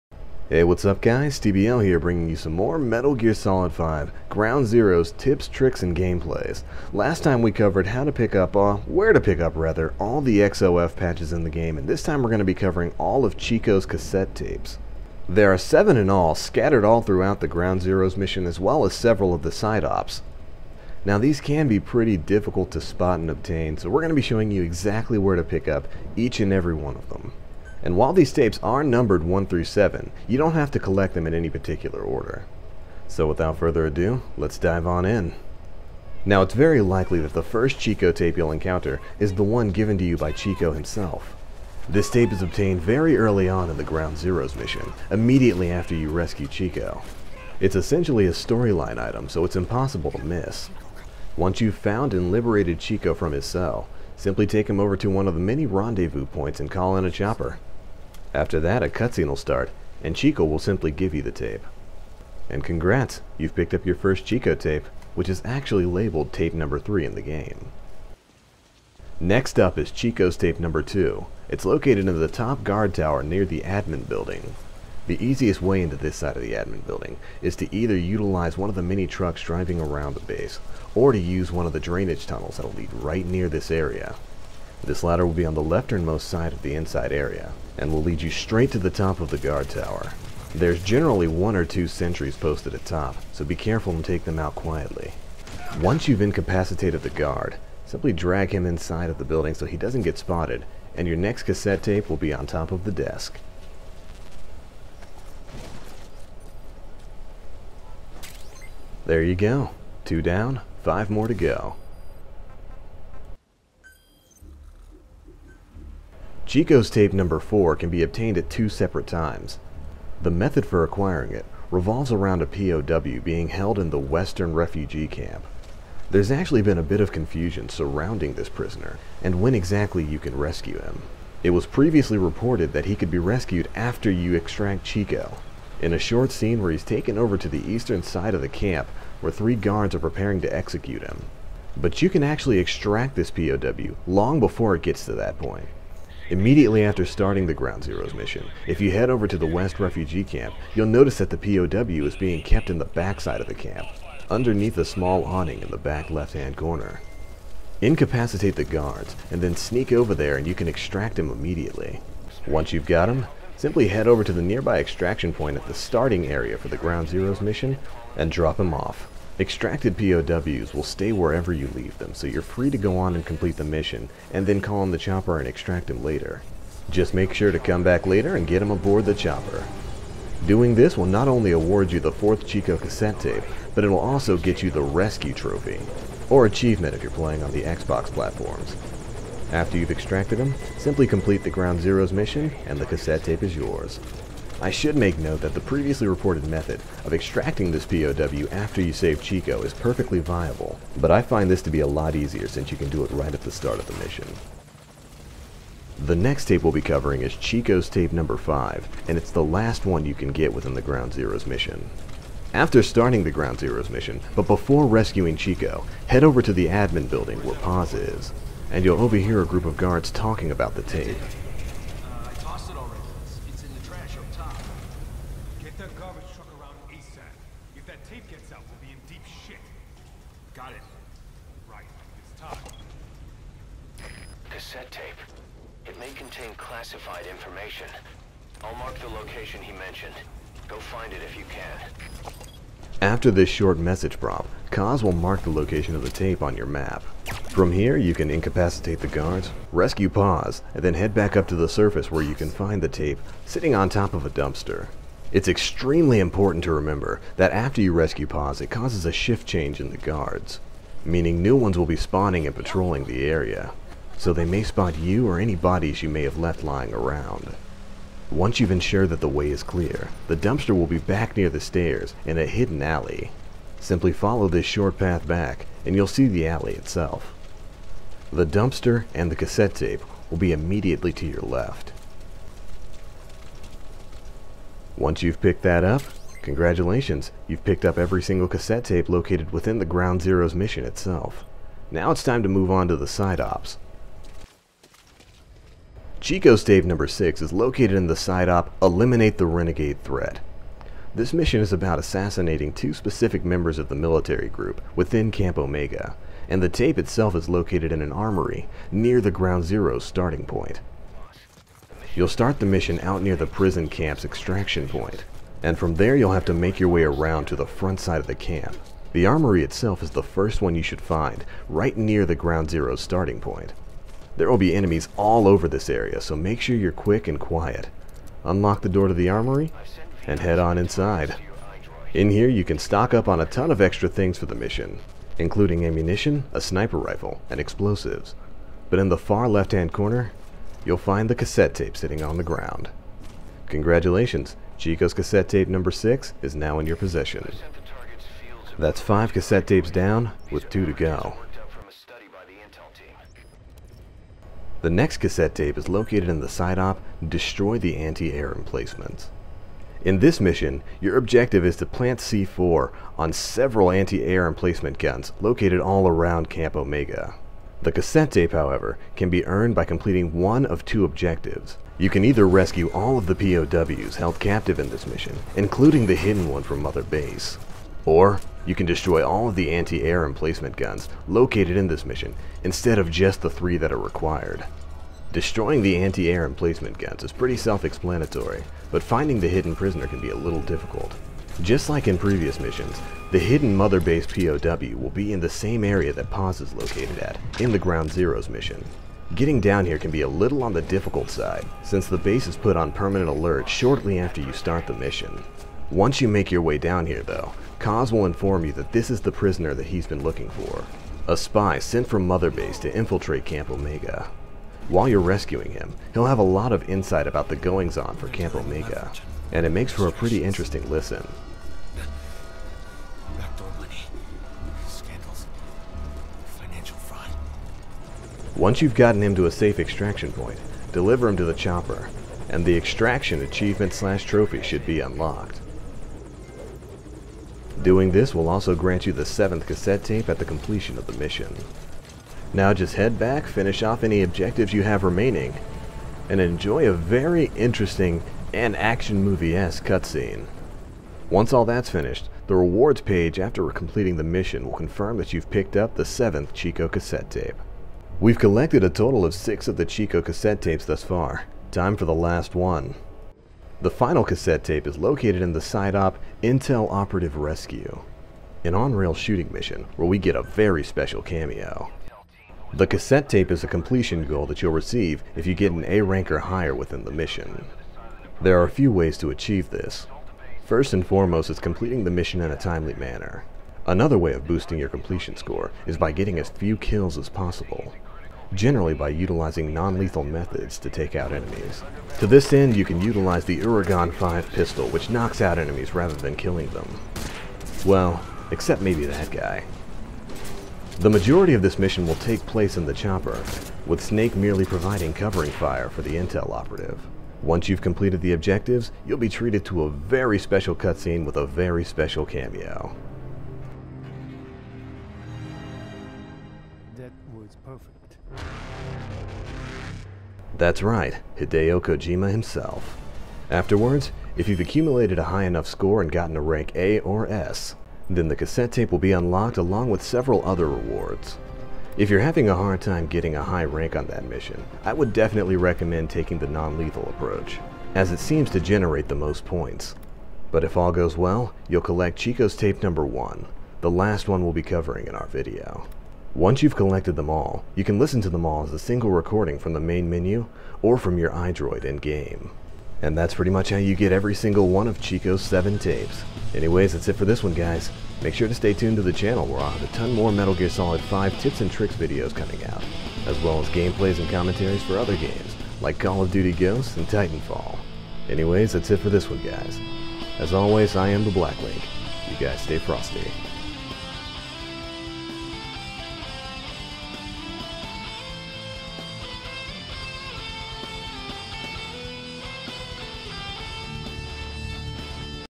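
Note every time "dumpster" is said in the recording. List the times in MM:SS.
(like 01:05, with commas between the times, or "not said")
04:14, 04:30, 04:38.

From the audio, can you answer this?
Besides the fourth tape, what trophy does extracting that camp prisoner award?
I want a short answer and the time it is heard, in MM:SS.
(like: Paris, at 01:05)
Rescue Trophy, at 03:04.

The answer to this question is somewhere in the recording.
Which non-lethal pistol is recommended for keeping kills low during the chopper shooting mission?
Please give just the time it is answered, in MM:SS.
08:13.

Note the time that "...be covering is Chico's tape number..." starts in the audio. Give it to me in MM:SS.
03:26.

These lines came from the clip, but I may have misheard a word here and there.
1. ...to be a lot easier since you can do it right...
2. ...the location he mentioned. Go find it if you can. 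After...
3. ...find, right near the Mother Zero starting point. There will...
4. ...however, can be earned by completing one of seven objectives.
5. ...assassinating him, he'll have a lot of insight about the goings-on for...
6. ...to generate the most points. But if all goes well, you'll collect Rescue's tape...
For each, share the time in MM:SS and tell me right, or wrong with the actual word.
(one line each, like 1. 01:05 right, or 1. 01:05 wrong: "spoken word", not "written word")
1. 03:21 right
2. 03:58 right
3. 05:21 wrong: "Ground", not "Mother"
4. 06:08 wrong: "two", not "seven"
5. 06:55 wrong: "rescuing", not "assassinating"
6. 08:58 wrong: "Chico", not "Rescue".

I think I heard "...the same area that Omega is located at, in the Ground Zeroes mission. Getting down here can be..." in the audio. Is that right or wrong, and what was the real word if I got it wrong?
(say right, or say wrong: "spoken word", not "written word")
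wrong: "Paz", not "Omega".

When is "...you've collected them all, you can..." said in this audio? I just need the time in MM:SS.
09:06.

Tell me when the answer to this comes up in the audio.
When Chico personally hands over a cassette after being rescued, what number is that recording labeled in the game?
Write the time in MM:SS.
01:06.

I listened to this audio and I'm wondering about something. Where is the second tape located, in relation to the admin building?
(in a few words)
top guard tower.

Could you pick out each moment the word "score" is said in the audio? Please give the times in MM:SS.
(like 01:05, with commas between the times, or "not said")
08:05, 08:45.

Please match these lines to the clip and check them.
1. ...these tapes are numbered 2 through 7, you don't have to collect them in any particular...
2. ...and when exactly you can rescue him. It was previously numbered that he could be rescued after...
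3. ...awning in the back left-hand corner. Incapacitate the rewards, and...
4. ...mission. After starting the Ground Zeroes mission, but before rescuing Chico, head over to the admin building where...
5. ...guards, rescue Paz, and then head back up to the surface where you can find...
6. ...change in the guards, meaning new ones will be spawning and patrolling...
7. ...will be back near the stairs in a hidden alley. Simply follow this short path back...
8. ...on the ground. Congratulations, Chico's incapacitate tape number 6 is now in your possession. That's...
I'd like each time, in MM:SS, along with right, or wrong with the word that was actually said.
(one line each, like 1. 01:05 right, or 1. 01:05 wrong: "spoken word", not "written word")
1. 00:28 wrong: "1", not "2"
2. 02:09 wrong: "reported", not "numbered"
3. 02:35 wrong: "guards", not "rewards"
4. 03:31 right
5. 04:09 right
6. 04:19 right
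7. 04:30 right
8. 05:42 wrong: "cassette", not "incapacitate".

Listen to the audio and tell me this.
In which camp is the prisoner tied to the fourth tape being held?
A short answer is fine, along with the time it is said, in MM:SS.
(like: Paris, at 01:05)
Western refugee camp, at 02:03.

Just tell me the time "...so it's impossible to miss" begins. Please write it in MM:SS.
00:49.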